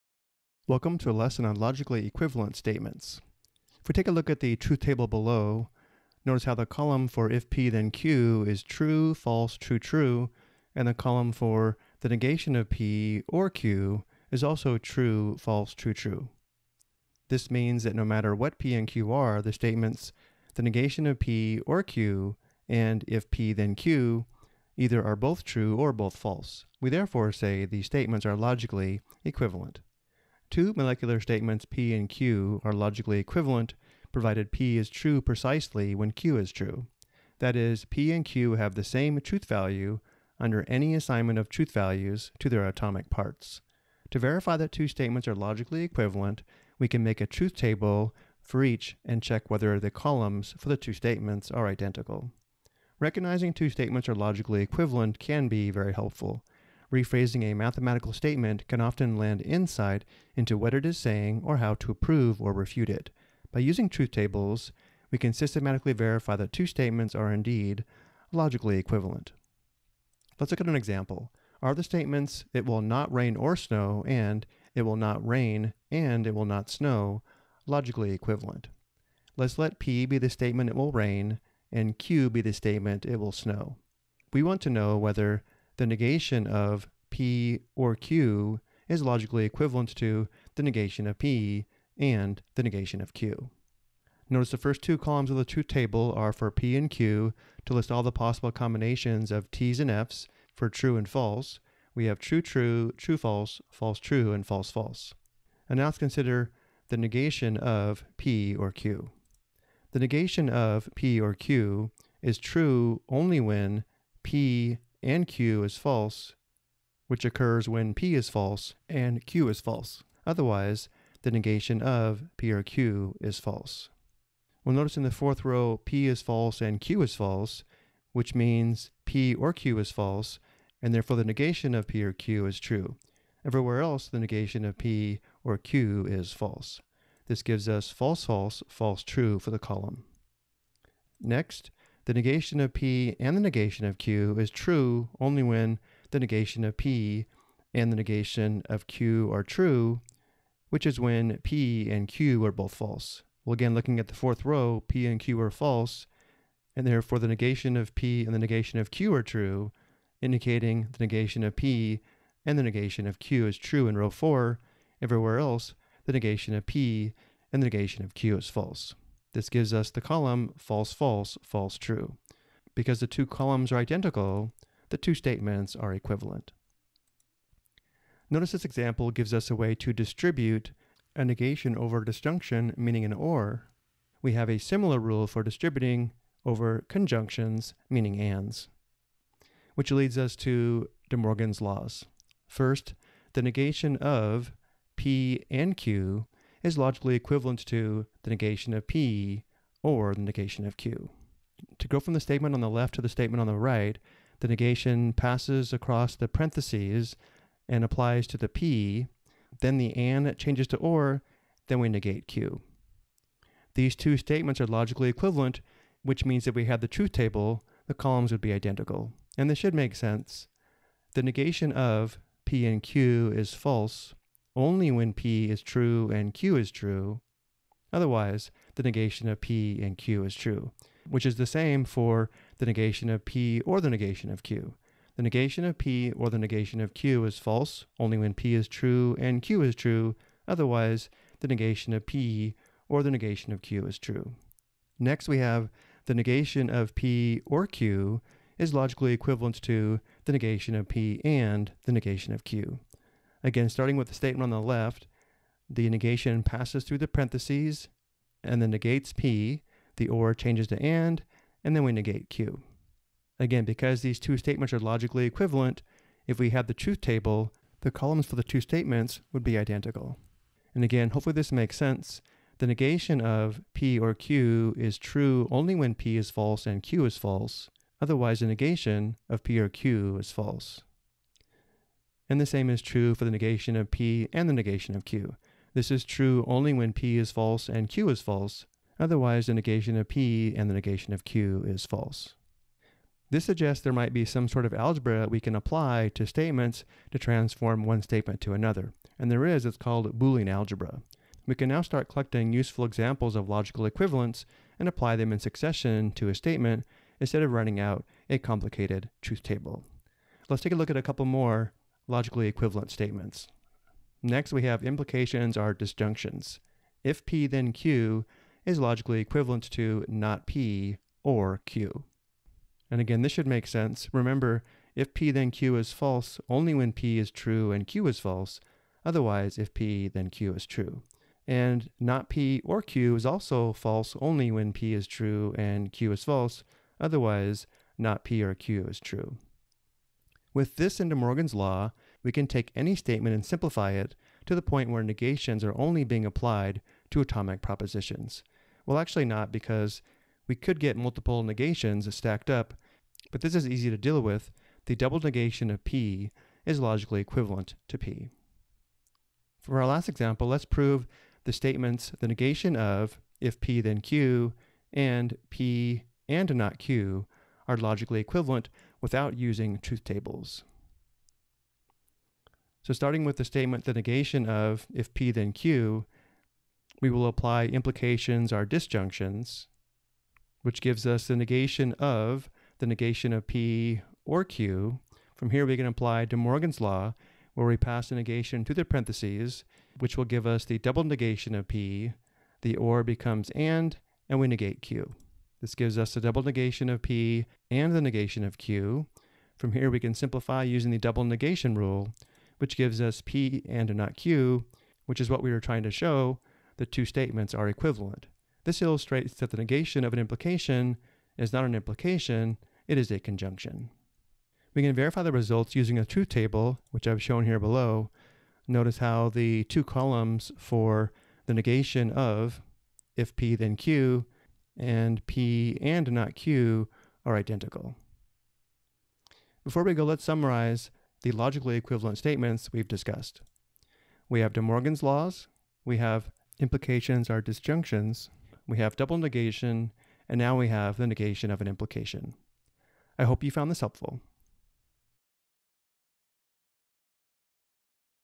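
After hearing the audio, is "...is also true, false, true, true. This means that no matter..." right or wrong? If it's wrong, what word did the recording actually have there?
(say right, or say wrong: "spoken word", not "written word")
right.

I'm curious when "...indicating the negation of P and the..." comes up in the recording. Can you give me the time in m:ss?
2:40.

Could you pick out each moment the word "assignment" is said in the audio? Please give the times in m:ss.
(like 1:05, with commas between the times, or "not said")
0:40.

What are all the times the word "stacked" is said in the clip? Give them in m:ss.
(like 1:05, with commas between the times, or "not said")
5:52.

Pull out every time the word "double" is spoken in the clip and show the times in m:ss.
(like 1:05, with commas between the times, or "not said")
5:54, 6:30, 6:36, 6:40, 7:18.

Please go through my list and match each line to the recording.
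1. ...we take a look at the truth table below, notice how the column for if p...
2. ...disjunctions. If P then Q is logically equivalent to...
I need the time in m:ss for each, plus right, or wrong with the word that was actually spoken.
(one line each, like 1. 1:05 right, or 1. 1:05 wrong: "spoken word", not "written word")
1. 0:03 right
2. 5:15 right.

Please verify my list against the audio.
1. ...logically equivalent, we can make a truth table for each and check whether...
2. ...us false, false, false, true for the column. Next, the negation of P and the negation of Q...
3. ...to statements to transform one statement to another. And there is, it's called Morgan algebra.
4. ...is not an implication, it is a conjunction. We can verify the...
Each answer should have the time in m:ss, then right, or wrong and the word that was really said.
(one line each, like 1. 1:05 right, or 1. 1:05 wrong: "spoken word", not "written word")
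1. 0:45 right
2. 2:17 right
3. 4:56 wrong: "Boolean", not "Morgan"
4. 6:51 right.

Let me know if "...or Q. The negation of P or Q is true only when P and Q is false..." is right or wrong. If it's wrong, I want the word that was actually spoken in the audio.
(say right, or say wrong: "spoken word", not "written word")
right.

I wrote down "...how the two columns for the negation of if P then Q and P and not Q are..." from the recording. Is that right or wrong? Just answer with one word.
right.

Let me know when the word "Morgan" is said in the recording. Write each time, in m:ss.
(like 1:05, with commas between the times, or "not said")
3:11, 5:41, 6:26, 7:14.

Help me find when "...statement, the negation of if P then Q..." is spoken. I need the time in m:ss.
6:13.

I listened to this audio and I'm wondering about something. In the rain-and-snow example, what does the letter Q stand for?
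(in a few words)
it will snow.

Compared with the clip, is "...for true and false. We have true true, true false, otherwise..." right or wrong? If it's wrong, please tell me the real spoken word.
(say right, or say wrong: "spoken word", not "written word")
wrong: "false", not "otherwise".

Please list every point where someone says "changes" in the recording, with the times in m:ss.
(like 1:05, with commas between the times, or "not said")
3:30, 4:20.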